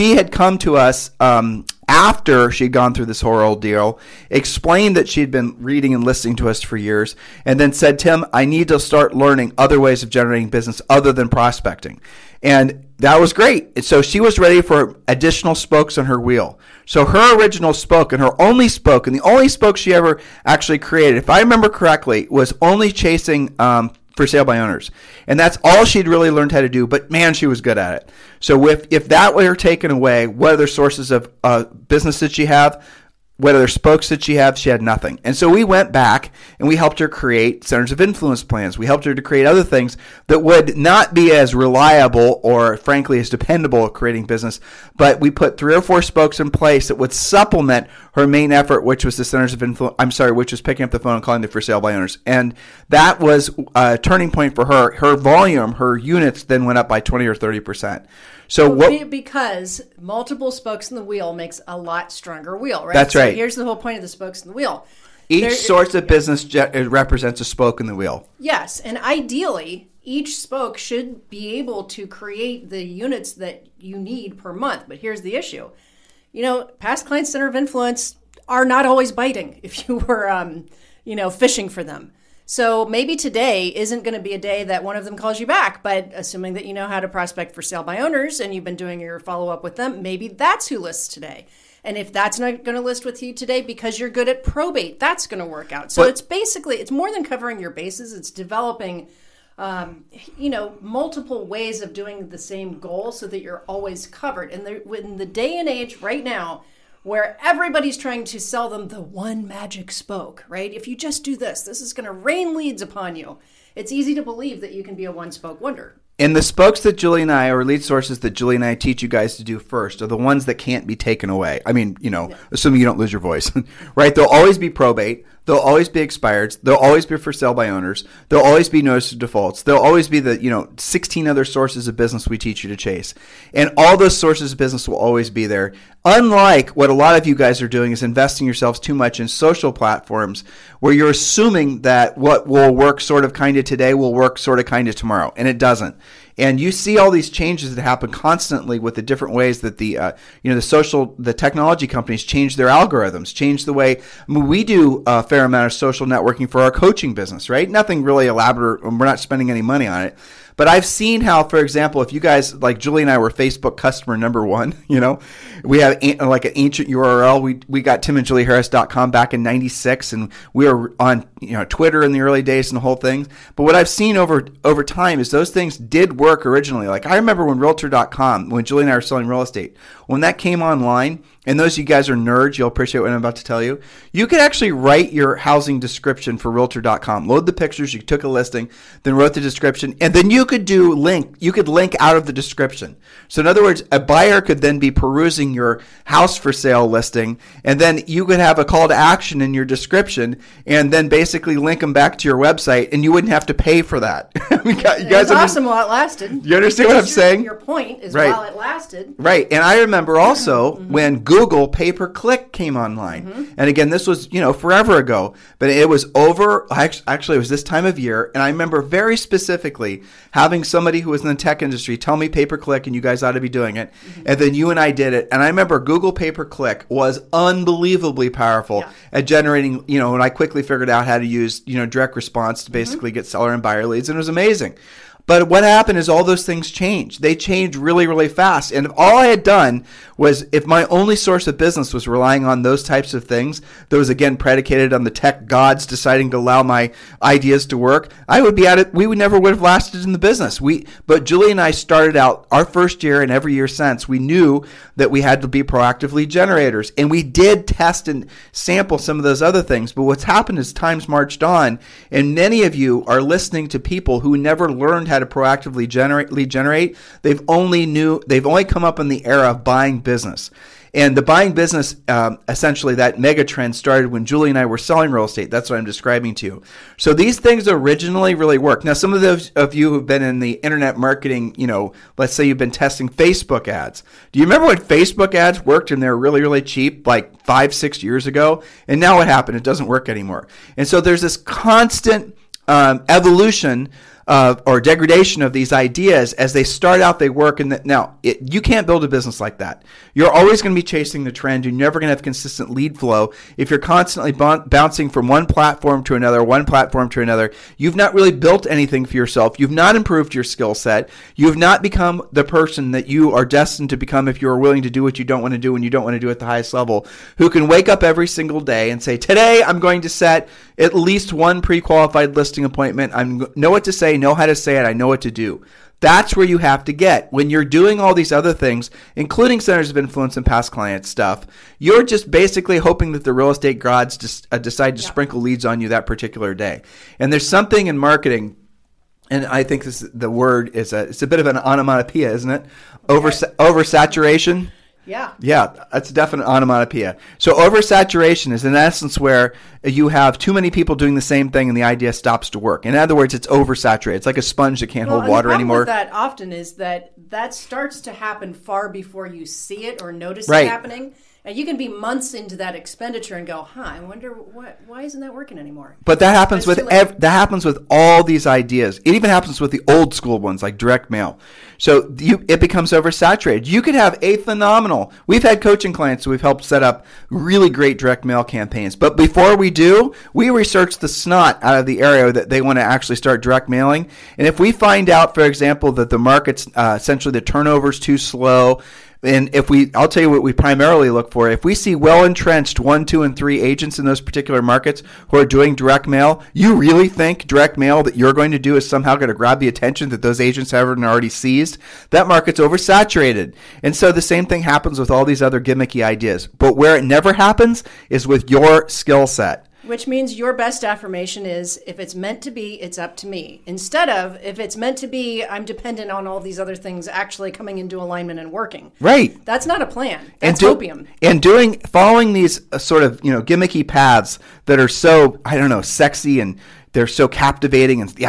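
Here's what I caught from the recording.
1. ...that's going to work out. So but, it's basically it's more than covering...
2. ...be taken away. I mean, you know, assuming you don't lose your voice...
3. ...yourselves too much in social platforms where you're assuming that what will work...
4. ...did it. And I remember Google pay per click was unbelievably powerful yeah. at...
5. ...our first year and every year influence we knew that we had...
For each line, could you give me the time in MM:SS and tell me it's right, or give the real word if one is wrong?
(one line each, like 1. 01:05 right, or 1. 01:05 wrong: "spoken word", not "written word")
1. 01:35 right
2. 02:00 right
3. 02:18 right
4. 03:44 right
5. 04:12 wrong: "since", not "influence".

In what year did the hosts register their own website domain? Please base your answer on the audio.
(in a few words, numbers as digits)
1996.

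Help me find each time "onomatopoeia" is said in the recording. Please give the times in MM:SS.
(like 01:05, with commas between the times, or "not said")
05:41, 05:46.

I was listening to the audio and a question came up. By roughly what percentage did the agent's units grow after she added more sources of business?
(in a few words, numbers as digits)
20 or 30%.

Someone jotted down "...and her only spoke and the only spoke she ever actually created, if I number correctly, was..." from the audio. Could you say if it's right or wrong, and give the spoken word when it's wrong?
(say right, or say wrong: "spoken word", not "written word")
wrong: "remember", not "number".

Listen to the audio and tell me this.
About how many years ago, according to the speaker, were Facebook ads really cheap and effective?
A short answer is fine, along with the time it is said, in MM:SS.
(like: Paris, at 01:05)
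5 or 6 years, at 04:47.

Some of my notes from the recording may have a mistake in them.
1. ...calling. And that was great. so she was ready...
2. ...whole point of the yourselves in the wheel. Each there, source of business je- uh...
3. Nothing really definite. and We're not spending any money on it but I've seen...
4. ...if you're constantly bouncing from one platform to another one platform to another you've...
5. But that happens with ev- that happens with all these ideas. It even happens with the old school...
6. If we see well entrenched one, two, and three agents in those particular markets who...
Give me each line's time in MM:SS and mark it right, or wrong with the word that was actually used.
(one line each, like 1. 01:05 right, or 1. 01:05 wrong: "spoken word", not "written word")
1. 00:11 wrong: "prospecting", not "calling"
2. 01:03 wrong: "spokes", not "yourselves"
3. 02:37 wrong: "elaborate", not "definite"
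4. 05:03 right
5. 06:06 right
6. 06:31 right.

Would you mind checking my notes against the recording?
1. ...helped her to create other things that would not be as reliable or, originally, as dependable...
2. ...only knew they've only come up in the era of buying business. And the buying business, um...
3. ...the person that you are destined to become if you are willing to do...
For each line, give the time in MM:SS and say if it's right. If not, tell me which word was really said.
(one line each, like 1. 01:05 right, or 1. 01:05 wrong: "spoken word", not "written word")
1. 00:38 wrong: "frankly", not "originally"
2. 04:27 right
3. 05:12 right.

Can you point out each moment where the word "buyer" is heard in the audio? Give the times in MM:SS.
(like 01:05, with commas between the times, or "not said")
03:14, 03:53.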